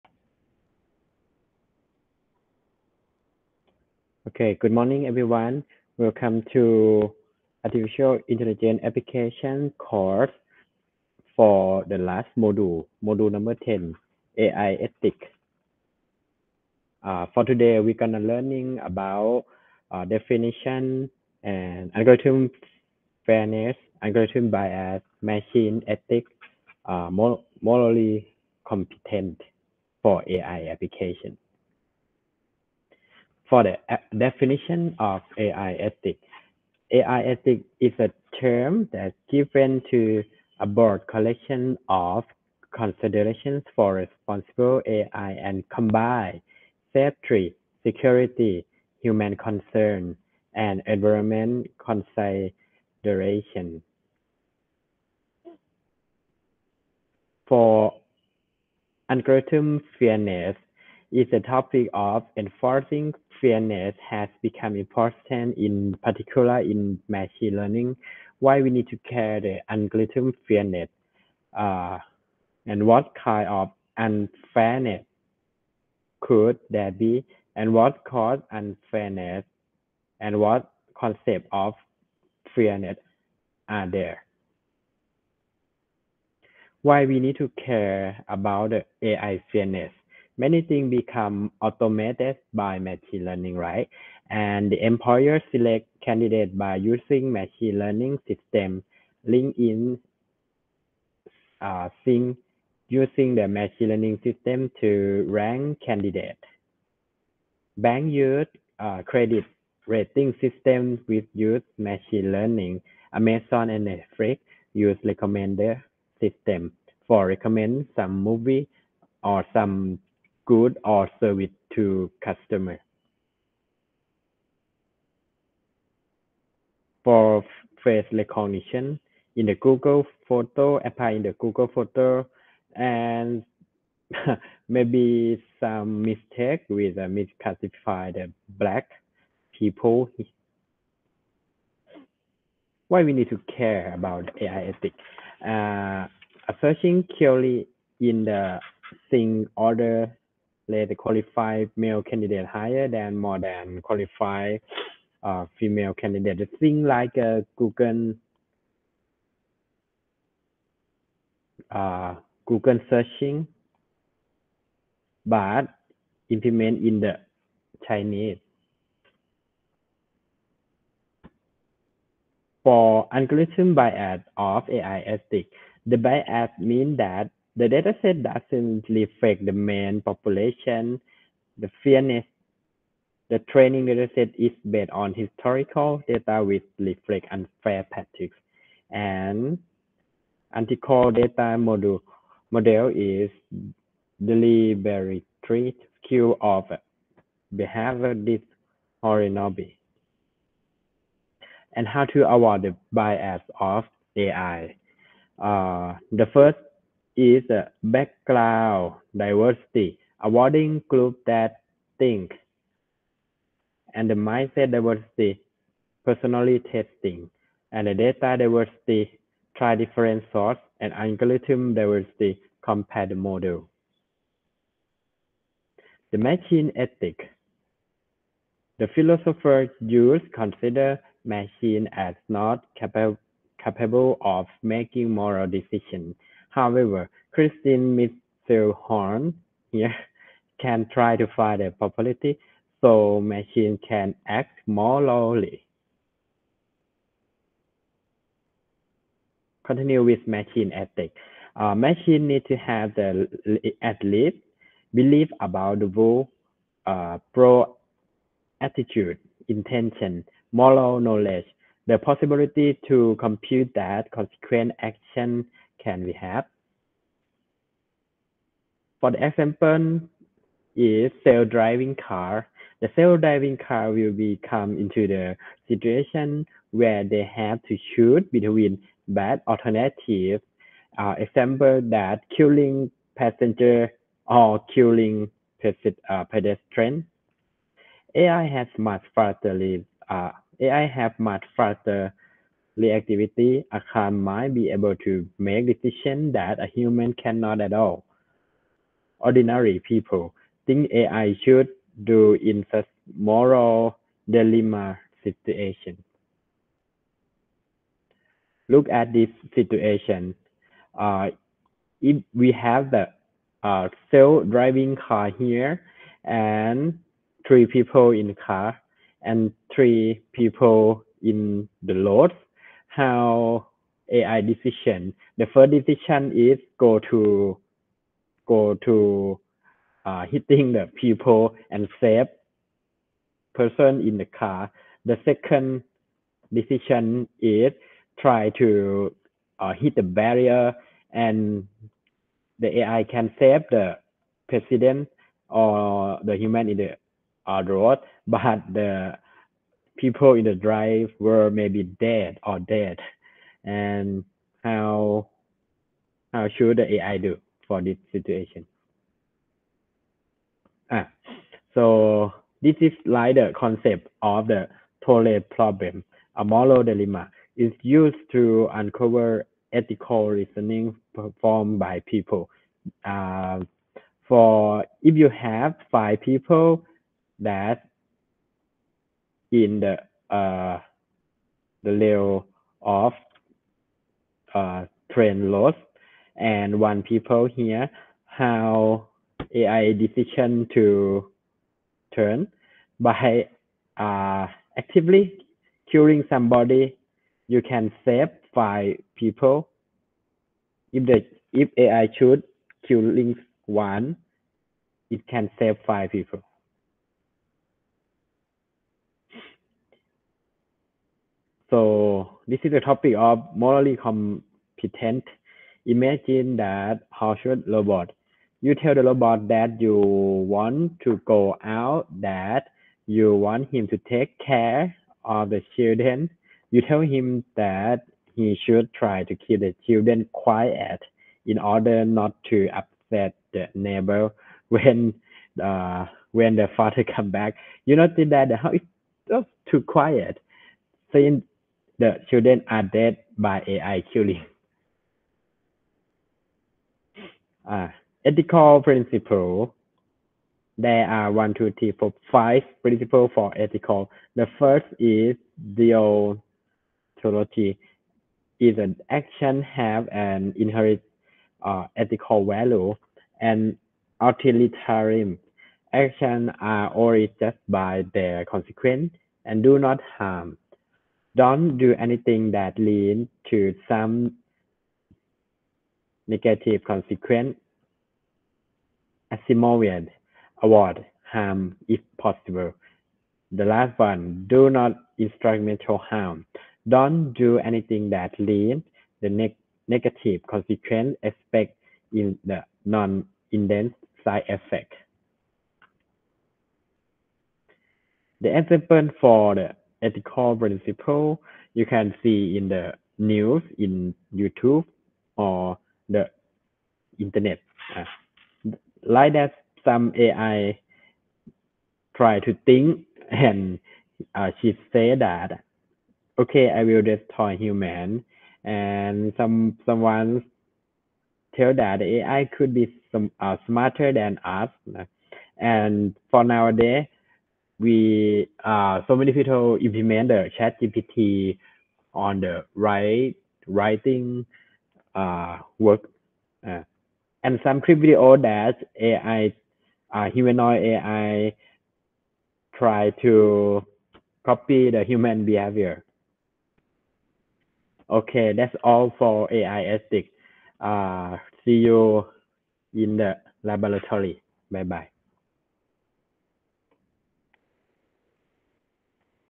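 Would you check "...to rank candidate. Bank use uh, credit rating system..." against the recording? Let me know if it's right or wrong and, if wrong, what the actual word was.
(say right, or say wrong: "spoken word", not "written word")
right.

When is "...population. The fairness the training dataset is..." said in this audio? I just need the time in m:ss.
3:00.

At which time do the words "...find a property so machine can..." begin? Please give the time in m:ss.
4:01.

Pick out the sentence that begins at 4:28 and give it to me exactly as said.
For the example is self-driving car.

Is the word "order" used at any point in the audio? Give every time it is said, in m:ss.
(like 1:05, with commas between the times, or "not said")
2:29, 7:11.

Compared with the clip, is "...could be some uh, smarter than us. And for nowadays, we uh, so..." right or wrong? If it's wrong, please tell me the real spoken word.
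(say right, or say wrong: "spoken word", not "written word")
right.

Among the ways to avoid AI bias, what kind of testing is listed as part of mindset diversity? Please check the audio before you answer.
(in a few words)
personality testing.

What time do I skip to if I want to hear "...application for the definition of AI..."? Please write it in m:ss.
0:30.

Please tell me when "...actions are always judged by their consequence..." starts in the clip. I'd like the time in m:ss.
7:45.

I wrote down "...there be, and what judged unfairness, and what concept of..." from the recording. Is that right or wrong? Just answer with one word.
wrong.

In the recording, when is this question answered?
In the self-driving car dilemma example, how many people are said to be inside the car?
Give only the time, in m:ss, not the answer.
5:17.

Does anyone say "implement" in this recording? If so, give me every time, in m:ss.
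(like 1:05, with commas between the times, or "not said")
2:46, 8:49.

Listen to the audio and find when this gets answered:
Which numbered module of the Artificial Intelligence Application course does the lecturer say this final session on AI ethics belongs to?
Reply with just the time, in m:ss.
0:13.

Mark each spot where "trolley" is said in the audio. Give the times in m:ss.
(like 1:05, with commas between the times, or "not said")
6:05.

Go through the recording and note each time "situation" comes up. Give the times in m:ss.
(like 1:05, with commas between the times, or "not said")
4:35, 5:05, 5:09, 5:58.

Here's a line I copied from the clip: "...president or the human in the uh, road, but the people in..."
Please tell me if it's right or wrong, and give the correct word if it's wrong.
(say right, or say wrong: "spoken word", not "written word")
right.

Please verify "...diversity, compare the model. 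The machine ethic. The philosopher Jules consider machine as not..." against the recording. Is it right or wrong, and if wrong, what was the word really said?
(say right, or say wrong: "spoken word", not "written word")
right.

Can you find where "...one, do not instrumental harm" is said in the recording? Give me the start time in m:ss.
8:03.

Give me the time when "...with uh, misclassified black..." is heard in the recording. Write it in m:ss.
2:16.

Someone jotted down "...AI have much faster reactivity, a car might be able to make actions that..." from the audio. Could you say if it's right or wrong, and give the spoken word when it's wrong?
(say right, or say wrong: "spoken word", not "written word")
wrong: "decisions", not "actions".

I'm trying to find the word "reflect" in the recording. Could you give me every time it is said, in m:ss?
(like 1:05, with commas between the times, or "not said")
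2:58, 3:06.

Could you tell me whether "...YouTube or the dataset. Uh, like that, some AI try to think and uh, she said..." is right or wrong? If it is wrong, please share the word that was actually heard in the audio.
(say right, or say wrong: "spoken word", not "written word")
wrong: "internet", not "dataset".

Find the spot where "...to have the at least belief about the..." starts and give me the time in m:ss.
4:12.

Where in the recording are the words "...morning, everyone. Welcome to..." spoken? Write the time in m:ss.
0:04.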